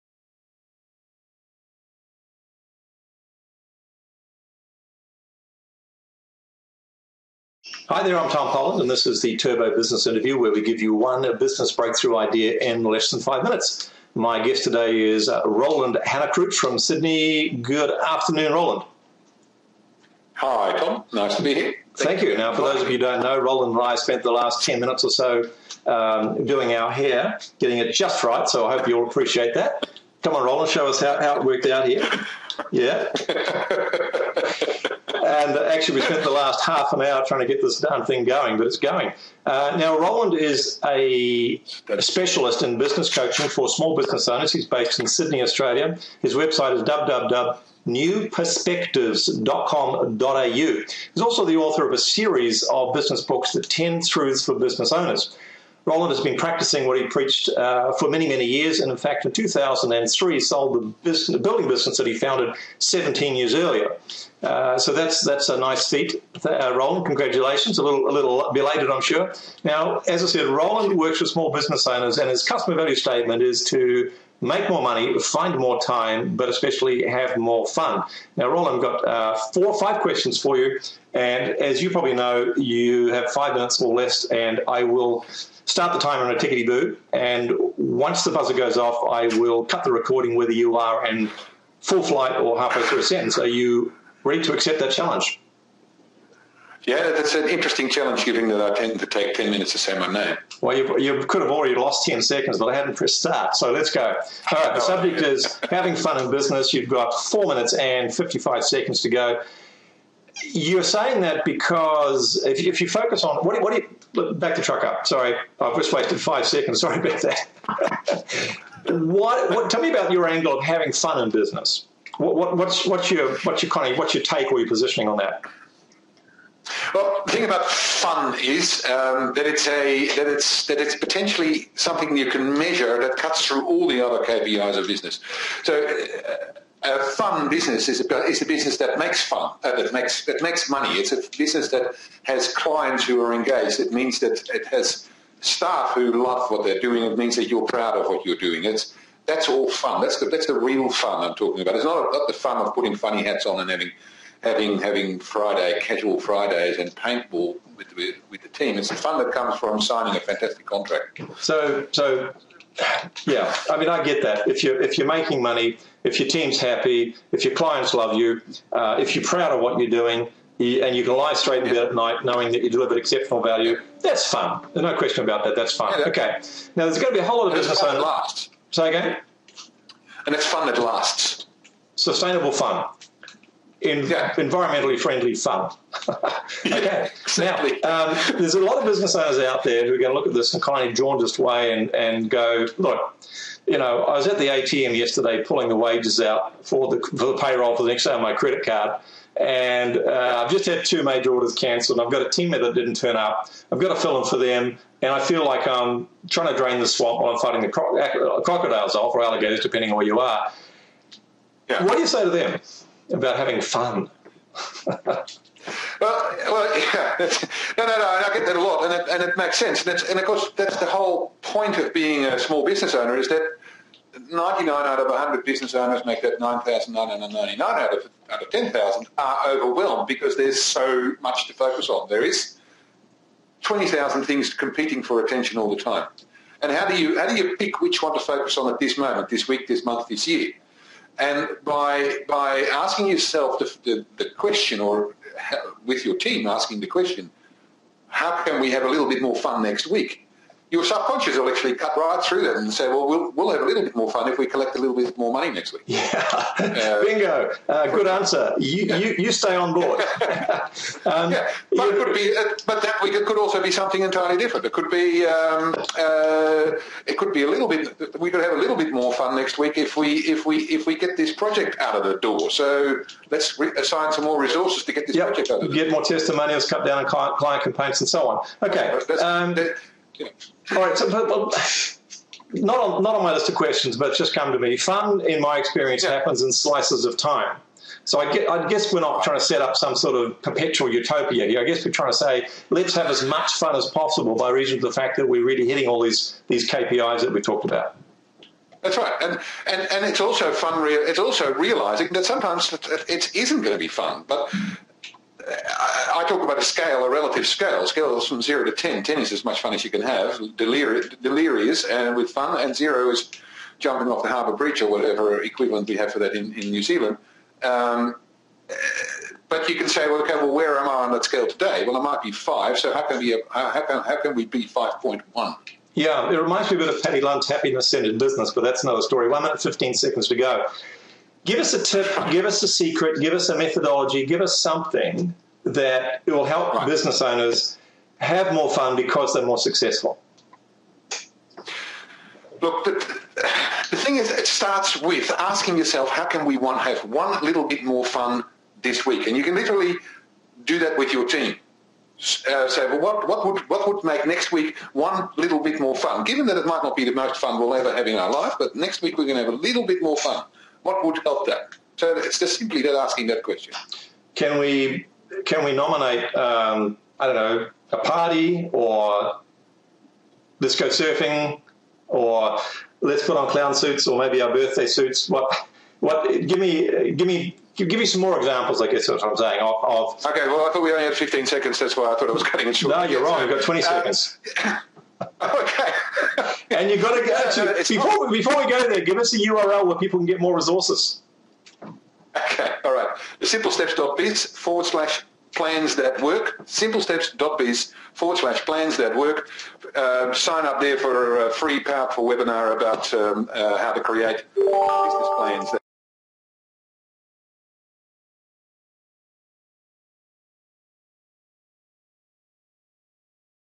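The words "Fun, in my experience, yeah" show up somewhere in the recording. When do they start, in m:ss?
4:44.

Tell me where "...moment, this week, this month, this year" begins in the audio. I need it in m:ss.
3:58.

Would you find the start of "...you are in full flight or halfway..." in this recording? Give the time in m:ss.
1:30.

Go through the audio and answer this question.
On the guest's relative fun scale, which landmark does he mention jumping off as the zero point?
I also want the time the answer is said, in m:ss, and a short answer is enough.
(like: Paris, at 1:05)
Harbour Bridge, at 5:14.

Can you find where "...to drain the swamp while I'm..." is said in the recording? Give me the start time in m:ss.
3:26.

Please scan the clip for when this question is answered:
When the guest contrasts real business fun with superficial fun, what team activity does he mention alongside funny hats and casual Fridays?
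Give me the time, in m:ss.
2:36.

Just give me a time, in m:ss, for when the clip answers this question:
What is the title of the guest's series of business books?
0:53.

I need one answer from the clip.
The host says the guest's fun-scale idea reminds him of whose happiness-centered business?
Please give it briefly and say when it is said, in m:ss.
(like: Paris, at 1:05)
Paddy Lund, at 5:27.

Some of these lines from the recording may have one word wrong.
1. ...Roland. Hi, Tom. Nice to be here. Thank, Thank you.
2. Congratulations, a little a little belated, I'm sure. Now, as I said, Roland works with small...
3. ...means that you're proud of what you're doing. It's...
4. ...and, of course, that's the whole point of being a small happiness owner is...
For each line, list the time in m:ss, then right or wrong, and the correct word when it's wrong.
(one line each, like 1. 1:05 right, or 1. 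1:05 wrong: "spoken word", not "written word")
1. 0:18 right
2. 1:07 right
3. 2:27 right
4. 3:40 wrong: "business", not "happiness".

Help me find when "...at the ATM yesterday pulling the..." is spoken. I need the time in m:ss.
3:14.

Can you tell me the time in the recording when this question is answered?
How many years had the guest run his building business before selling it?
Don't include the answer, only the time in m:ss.
1:02.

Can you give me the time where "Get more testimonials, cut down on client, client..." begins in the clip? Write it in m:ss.
4:35.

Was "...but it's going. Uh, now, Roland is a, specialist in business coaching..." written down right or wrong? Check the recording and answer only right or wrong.
right.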